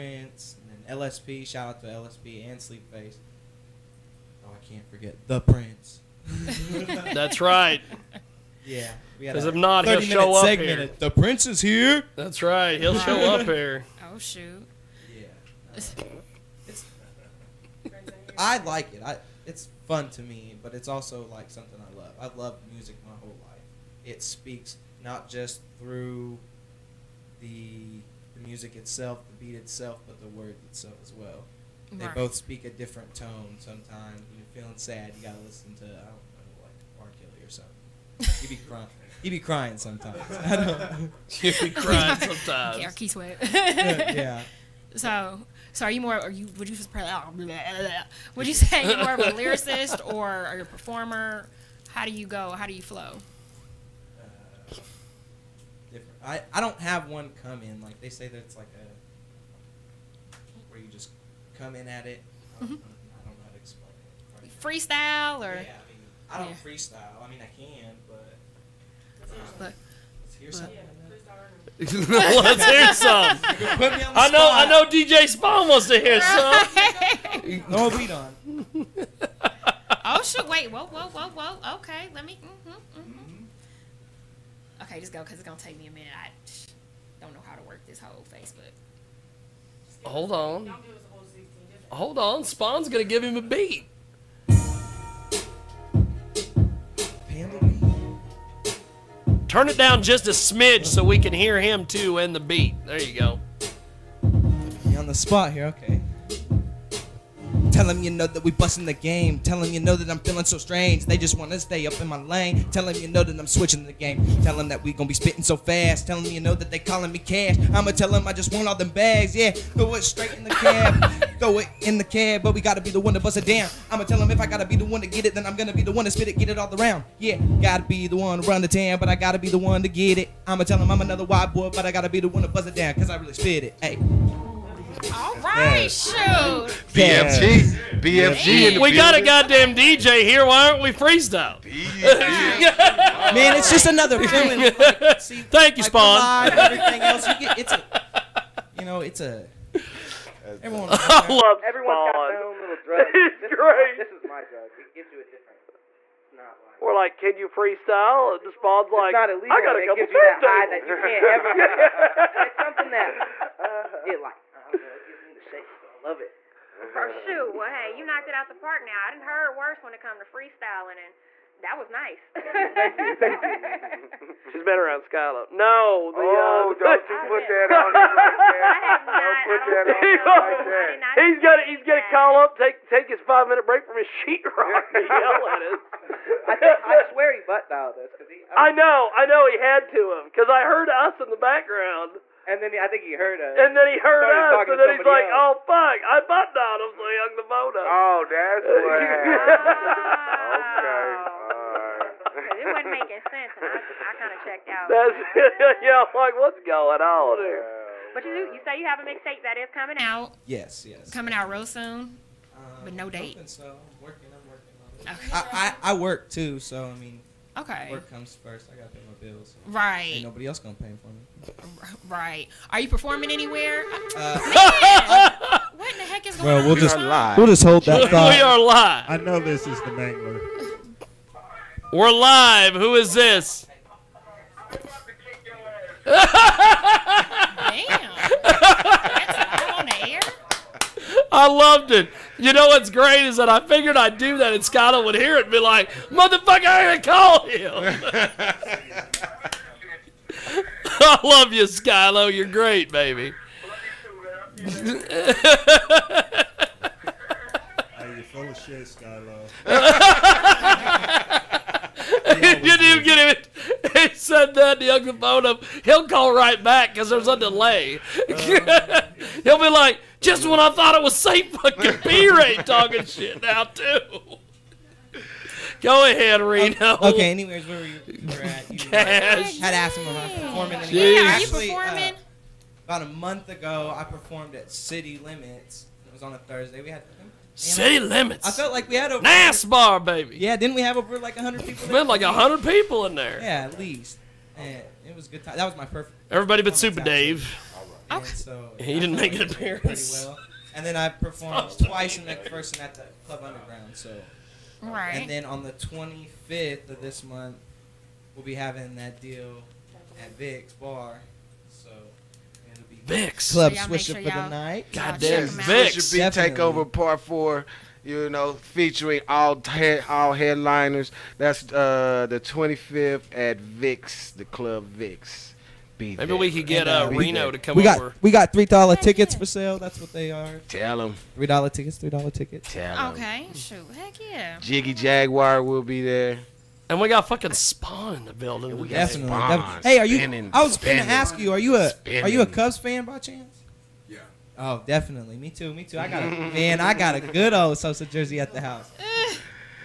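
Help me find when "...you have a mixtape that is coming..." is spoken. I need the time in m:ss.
3:28.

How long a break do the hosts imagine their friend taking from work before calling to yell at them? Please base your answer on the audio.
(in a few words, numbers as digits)
5 minutes.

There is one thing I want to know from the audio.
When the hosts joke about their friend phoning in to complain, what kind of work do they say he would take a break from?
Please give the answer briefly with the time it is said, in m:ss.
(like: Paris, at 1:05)
sheetrock, at 3:04.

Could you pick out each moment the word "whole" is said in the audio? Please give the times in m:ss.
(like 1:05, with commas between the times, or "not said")
0:23, 1:27.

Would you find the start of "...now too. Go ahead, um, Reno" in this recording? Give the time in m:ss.
4:33.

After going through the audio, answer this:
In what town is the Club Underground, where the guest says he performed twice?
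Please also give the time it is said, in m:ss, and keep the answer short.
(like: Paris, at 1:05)
McPherson, at 5:02.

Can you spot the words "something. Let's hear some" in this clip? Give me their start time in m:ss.
1:10.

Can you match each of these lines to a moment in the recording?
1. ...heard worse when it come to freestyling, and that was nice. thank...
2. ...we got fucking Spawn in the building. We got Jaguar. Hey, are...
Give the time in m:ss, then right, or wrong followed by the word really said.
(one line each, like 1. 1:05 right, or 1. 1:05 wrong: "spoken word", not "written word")
1. 2:49 right
2. 5:36 wrong: "Spawn", not "Jaguar".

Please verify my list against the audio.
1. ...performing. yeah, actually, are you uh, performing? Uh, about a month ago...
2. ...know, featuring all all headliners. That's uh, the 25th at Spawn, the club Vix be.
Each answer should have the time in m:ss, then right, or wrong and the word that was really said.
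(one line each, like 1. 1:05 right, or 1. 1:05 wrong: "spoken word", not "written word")
1. 4:40 right
2. 5:18 wrong: "Vix", not "Spawn".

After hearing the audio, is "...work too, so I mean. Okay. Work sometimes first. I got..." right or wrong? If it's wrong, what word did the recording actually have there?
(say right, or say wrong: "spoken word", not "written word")
wrong: "comes", not "sometimes".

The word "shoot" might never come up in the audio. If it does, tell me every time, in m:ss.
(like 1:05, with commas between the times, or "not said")
0:14, 2:15, 2:47, 5:33.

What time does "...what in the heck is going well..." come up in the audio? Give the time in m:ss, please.
3:45.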